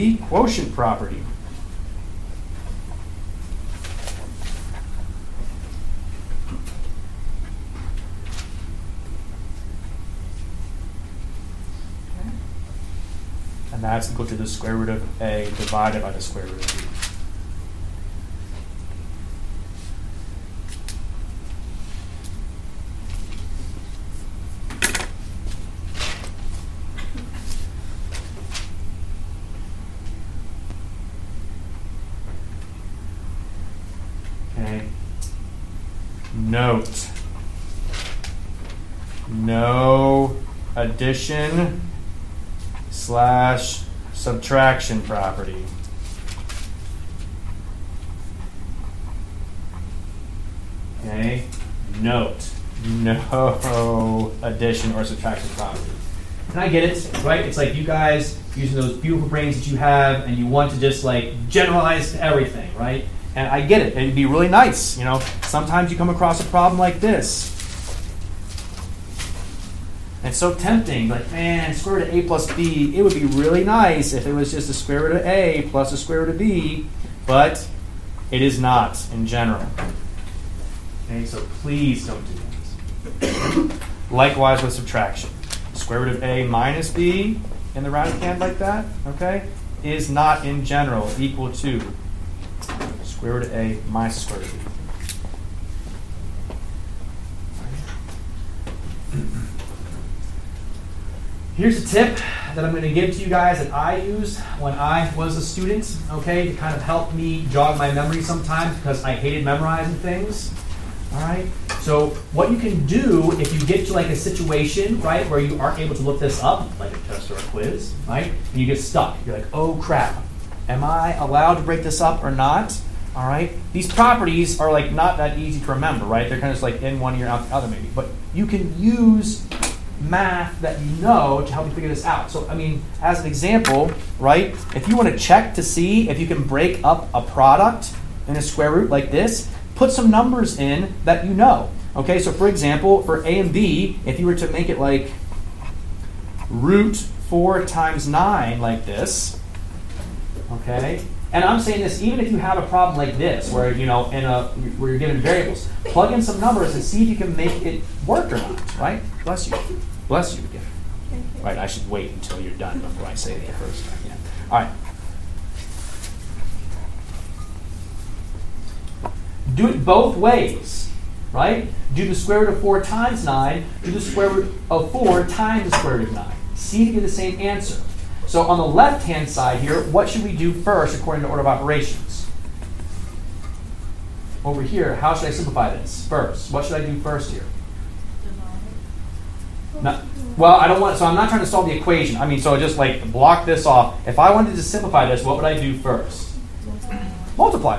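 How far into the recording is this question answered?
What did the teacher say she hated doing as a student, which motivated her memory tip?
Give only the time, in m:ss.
1:49.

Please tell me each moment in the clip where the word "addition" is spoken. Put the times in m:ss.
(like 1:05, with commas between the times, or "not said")
0:40, 0:54.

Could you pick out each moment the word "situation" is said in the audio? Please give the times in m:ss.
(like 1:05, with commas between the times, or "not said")
1:54.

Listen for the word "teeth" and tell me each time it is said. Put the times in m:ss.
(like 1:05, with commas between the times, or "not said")
not said.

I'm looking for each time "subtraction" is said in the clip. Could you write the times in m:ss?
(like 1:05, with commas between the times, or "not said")
0:44, 0:55, 1:24.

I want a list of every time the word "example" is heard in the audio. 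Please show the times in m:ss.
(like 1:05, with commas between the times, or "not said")
2:13, 2:22.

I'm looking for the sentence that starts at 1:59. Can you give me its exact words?
You're like, oh crap, am I allowed to break this up or not?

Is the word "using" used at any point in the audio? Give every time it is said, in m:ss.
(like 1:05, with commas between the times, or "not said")
0:58.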